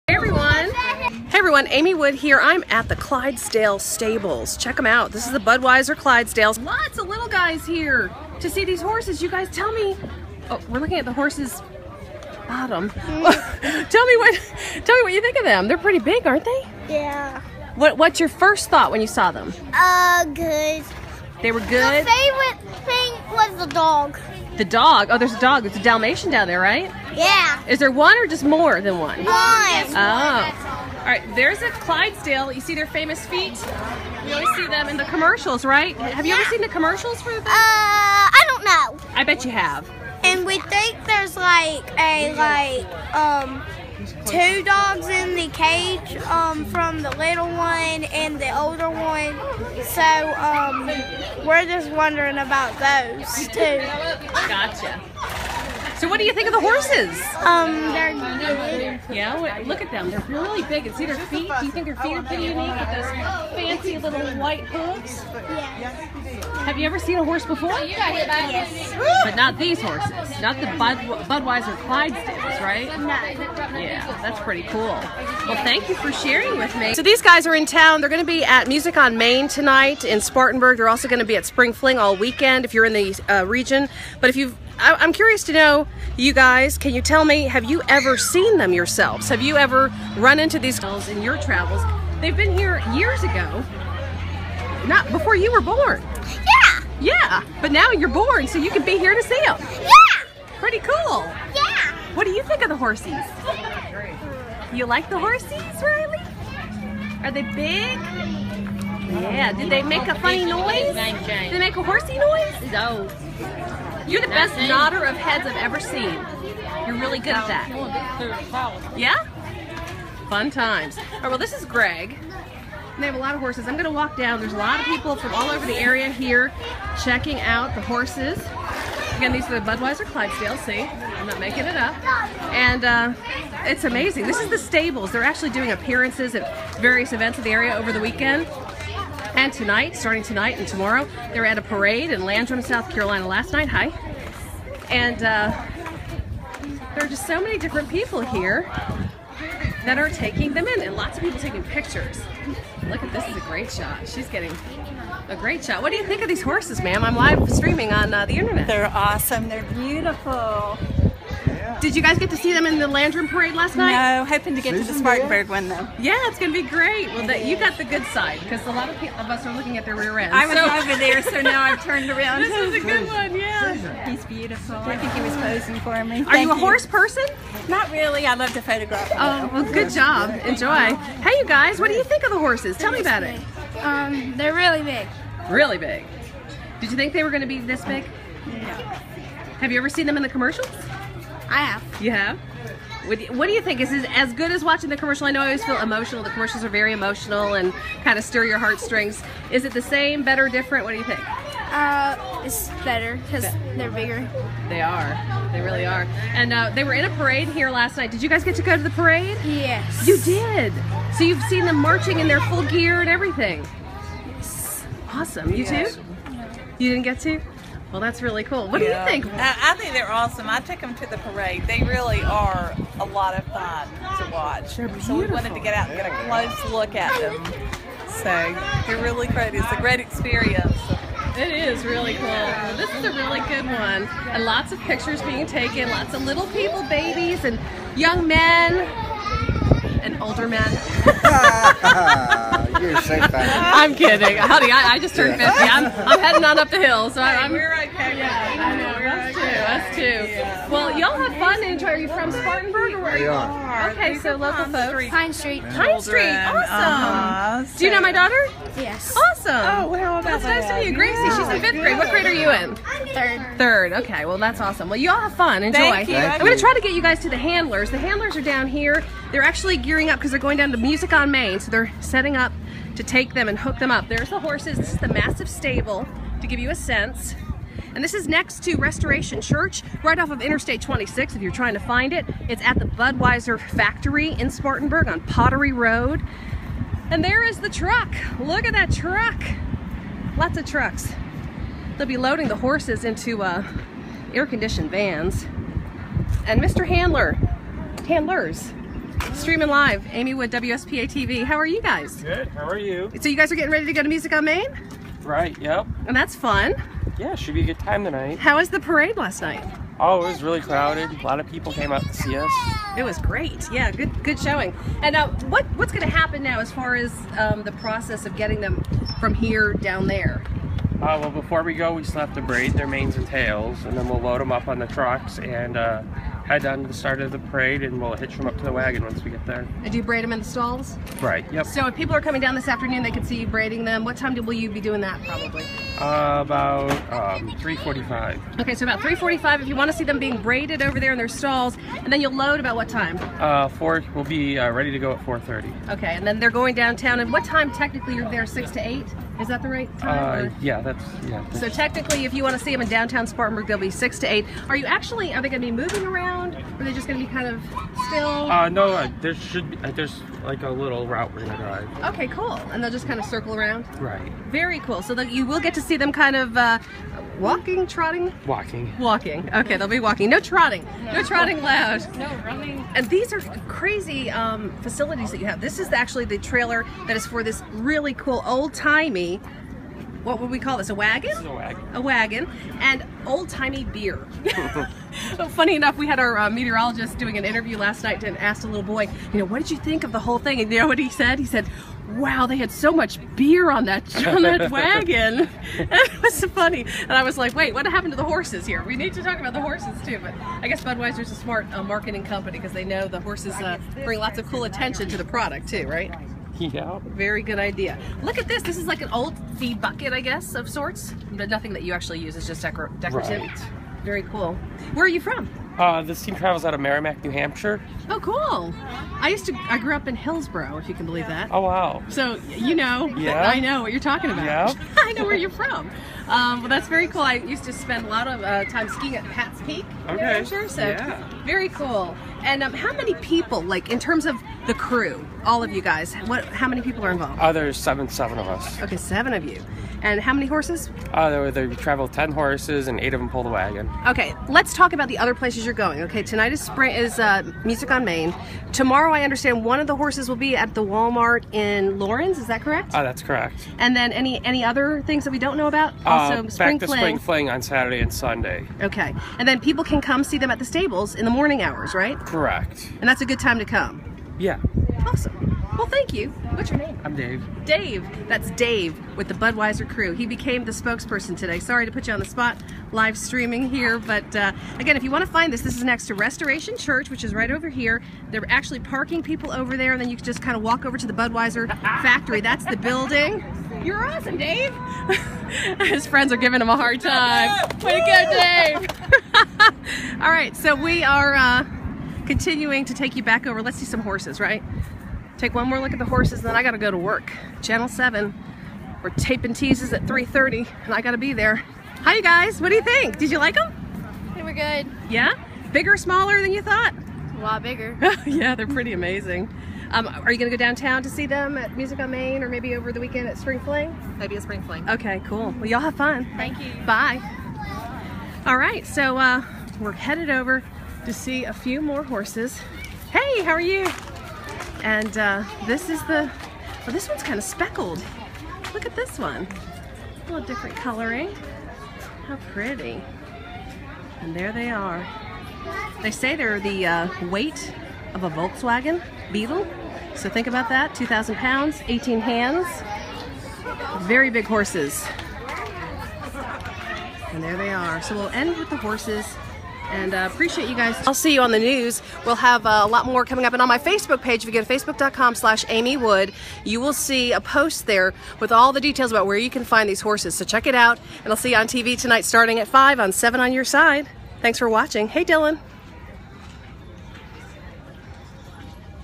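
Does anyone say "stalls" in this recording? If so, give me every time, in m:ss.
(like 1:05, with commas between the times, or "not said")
5:30, 5:41.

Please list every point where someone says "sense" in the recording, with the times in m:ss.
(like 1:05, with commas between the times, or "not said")
4:36.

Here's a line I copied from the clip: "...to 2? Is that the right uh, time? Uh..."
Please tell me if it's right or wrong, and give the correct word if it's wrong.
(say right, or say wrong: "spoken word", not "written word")
wrong: "8", not "2".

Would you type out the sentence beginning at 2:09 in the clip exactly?
Again, these are the Budweiser Clydesdale.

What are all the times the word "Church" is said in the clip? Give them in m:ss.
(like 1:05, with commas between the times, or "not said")
4:39, 7:56.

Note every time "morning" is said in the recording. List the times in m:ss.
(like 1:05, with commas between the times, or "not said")
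7:41.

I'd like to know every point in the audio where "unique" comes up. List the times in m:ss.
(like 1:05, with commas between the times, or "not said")
0:58, 1:02.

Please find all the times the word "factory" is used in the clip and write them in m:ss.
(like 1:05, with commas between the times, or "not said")
4:43, 8:01.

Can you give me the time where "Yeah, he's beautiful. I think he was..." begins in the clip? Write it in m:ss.
2:53.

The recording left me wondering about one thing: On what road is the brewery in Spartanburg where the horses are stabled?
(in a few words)
Pottery Road.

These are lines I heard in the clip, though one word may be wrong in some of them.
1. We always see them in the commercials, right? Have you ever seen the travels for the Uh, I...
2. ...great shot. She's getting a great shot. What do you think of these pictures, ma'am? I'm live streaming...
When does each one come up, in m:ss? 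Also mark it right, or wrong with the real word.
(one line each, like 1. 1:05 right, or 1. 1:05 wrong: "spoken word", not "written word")
1. 0:34 wrong: "commercials", not "travels"
2. 2:33 wrong: "horses", not "pictures".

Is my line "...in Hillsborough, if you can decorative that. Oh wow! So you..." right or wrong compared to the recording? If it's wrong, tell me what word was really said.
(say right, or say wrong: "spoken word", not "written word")
wrong: "believe", not "decorative".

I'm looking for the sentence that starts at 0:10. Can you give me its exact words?
Oh, we're looking at the horses bottom.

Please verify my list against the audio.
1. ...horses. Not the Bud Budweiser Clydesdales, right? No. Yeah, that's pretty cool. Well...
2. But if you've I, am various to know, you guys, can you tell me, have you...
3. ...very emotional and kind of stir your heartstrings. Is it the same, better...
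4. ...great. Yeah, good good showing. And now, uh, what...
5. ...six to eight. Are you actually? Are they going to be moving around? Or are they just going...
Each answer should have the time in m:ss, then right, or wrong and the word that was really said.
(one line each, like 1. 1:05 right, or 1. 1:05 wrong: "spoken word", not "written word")
1. 1:09 right
2. 1:24 wrong: "curious", not "various"
3. 3:16 right
4. 5:13 right
5. 5:53 right.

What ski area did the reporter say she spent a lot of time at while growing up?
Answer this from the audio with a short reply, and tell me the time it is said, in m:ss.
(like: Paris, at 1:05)
Pat's Peak, at 7:09.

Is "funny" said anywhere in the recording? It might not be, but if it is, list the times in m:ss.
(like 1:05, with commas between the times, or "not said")
1:50, 6:25, 6:36.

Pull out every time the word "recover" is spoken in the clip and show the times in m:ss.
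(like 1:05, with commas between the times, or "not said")
not said.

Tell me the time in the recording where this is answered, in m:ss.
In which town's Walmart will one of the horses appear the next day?
7:31.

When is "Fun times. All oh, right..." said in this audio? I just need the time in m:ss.
2:00.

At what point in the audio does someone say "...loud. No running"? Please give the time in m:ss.
6:11.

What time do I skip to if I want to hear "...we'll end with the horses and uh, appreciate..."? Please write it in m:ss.
9:08.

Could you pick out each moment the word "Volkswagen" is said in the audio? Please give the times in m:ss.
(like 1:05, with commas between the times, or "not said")
8:58.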